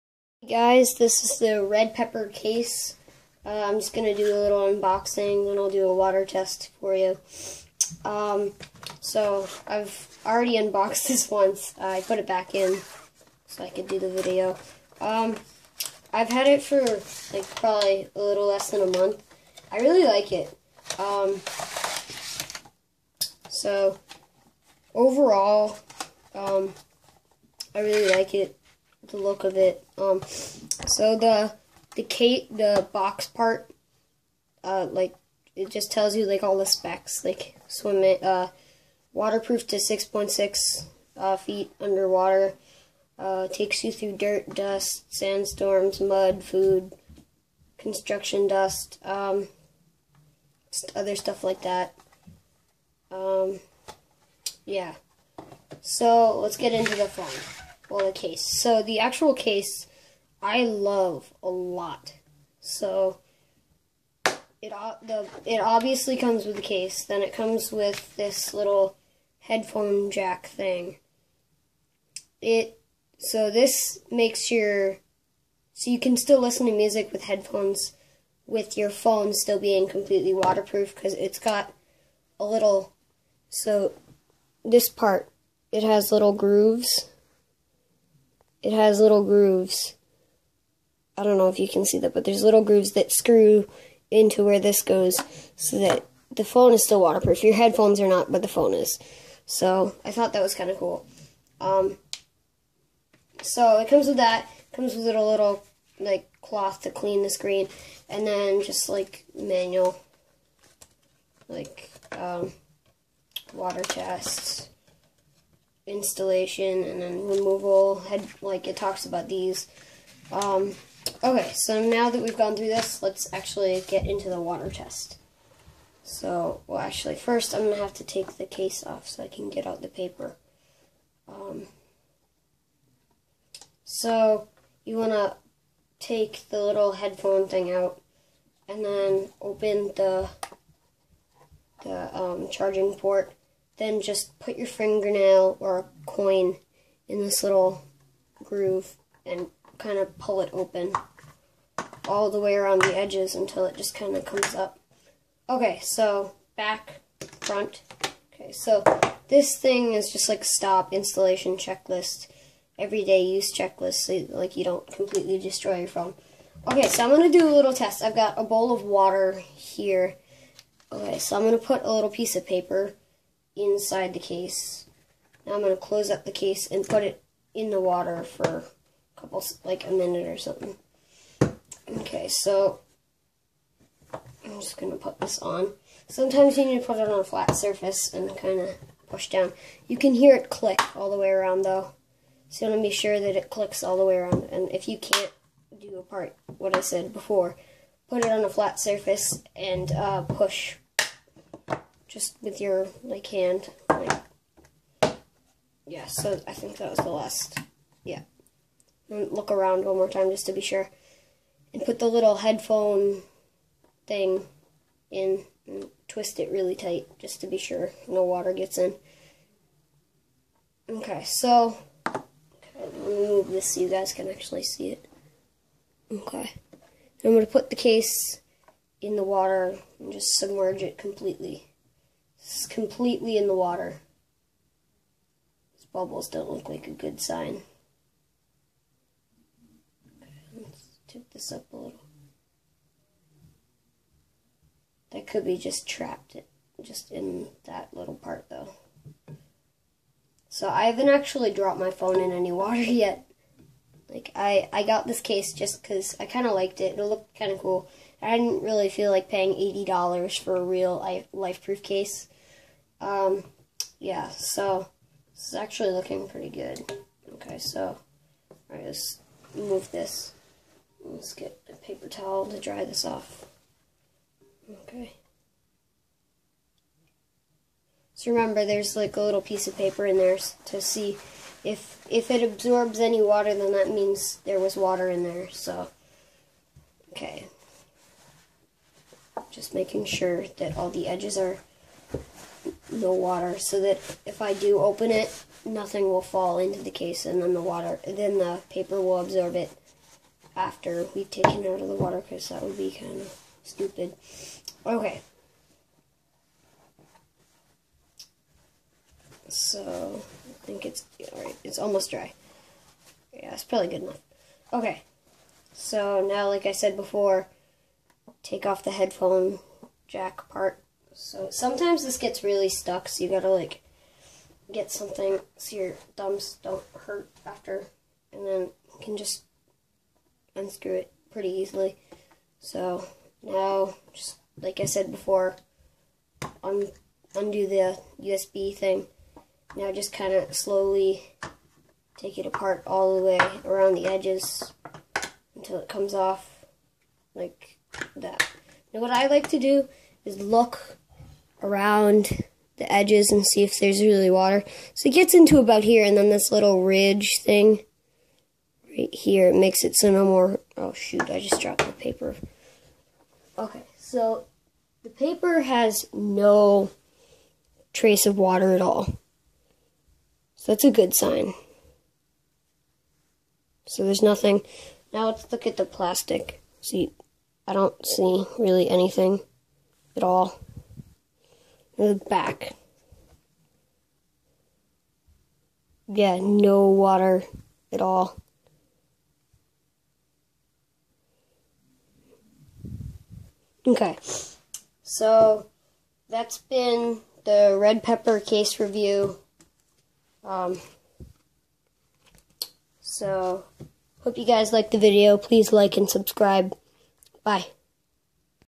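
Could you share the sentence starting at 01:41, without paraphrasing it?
Um, so it comes with that.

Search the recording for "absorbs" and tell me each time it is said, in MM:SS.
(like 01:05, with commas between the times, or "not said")
04:42, 04:59.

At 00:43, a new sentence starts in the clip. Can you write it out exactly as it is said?
Uh, takes you through dirt, dust, sandstorms, mud, food, construction dust, um, other stuff like that.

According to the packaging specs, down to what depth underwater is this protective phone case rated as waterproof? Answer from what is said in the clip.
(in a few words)
6.6 feet.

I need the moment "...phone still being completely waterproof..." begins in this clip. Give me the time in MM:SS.
01:18.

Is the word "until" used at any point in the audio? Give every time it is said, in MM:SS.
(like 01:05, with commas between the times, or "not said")
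02:33, 05:45.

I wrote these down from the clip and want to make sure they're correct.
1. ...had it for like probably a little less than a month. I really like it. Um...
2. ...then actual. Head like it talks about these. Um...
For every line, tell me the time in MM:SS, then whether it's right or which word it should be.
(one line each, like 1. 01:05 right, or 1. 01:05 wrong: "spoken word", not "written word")
1. 00:16 right
2. 01:57 wrong: "removal", not "actual".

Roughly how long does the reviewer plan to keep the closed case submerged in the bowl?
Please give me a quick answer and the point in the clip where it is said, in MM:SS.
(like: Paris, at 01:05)
a minute, at 02:59.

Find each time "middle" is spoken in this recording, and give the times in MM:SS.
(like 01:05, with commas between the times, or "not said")
not said.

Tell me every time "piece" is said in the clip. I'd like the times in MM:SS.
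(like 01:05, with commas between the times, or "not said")
02:52, 04:39.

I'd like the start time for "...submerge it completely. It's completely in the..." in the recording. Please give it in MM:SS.
03:50.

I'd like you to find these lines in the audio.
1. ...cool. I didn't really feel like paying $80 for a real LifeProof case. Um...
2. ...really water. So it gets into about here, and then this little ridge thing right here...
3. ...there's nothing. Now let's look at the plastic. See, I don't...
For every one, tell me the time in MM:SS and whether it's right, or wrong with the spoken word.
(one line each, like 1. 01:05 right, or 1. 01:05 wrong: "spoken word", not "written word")
1. 04:17 right
2. 05:54 right
3. 06:14 right.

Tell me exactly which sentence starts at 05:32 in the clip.
So now, just like I said before, un undo the USB thing.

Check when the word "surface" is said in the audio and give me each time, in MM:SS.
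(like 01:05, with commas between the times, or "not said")
03:07, 03:18.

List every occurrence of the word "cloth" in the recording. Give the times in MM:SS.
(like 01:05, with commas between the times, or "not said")
01:46.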